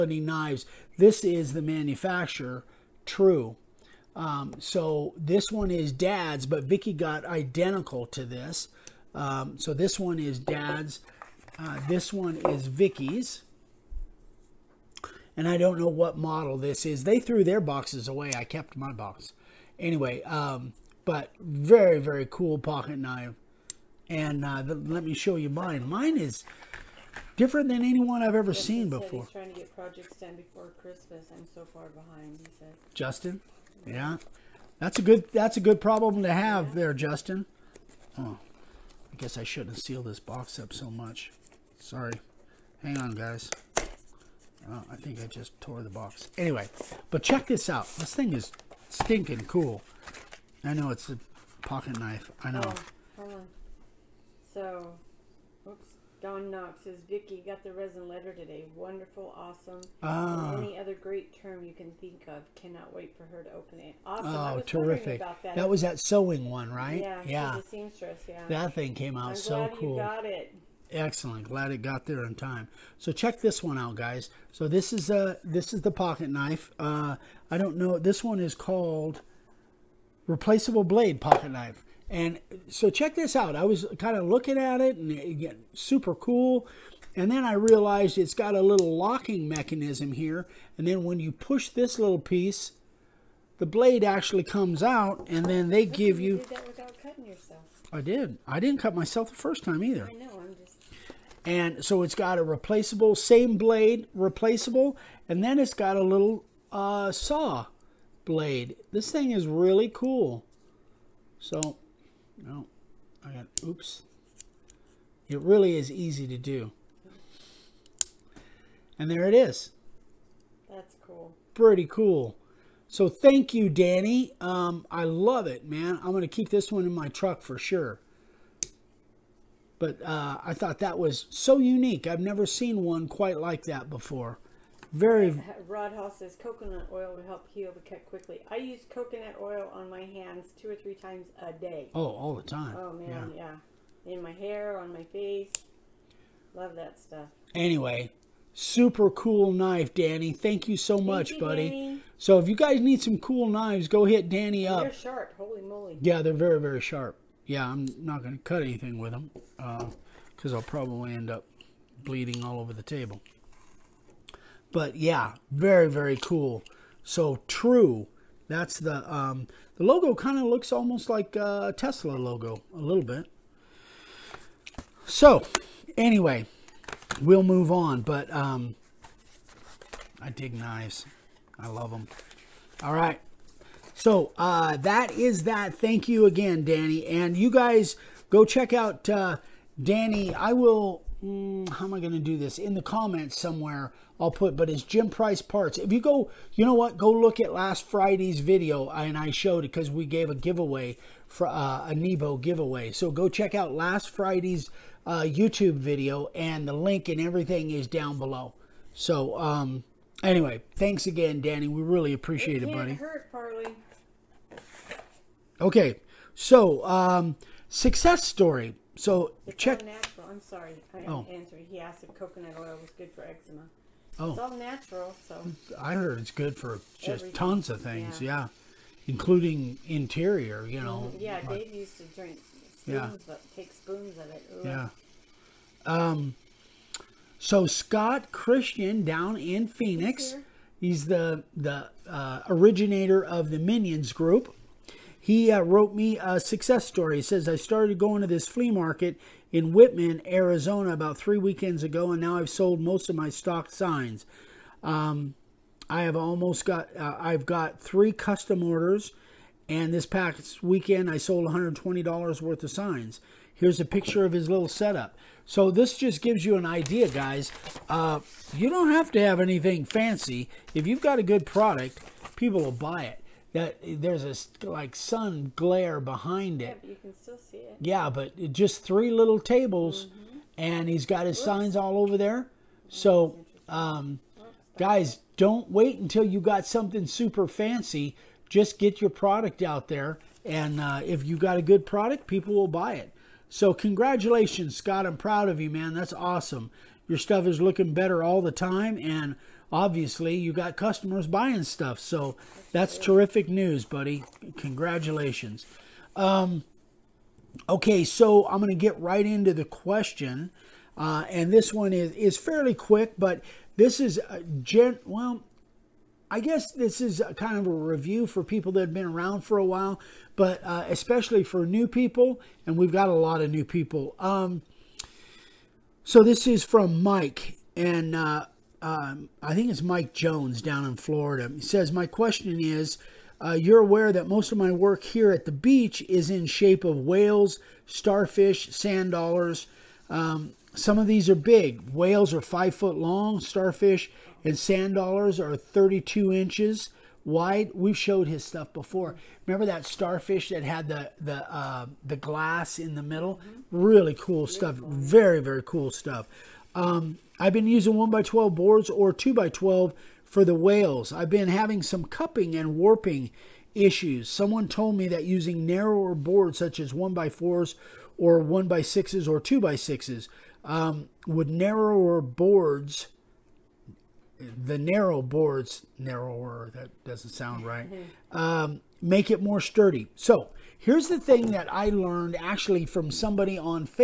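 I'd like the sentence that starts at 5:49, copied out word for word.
Remember that starfish that had the the uh, the glass in the middle?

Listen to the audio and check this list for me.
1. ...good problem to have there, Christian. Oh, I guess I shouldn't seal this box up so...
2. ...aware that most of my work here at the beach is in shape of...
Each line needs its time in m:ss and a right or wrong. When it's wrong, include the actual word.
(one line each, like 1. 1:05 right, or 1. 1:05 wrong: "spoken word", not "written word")
1. 0:35 wrong: "Justin", not "Christian"
2. 5:33 right.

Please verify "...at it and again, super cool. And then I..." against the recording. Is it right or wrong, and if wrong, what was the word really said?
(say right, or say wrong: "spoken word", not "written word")
right.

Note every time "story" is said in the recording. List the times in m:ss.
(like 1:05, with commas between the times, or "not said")
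3:38, 4:06.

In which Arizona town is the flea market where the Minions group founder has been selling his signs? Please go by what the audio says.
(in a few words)
Wittmann.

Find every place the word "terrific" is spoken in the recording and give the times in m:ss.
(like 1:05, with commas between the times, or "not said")
1:04, 5:02.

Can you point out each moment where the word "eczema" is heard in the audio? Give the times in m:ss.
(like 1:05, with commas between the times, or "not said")
3:43.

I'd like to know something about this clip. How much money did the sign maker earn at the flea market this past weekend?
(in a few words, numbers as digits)
$120.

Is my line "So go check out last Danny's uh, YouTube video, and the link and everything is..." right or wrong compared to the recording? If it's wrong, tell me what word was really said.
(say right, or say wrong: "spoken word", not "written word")
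wrong: "Friday", not "Danny".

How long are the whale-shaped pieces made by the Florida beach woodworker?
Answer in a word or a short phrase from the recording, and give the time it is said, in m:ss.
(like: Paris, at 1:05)
5 feet, at 5:42.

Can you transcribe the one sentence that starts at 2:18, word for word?
I use coconut oil on my hands two or three times a day.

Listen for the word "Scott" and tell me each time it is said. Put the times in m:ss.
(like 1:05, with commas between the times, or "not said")
3:57, 4:54.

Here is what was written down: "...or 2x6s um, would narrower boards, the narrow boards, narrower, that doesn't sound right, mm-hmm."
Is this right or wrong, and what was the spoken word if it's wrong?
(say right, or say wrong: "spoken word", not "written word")
right.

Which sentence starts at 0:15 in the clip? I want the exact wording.
And I don't know what model this is.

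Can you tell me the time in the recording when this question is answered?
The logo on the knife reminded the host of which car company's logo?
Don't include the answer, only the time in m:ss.
2:51.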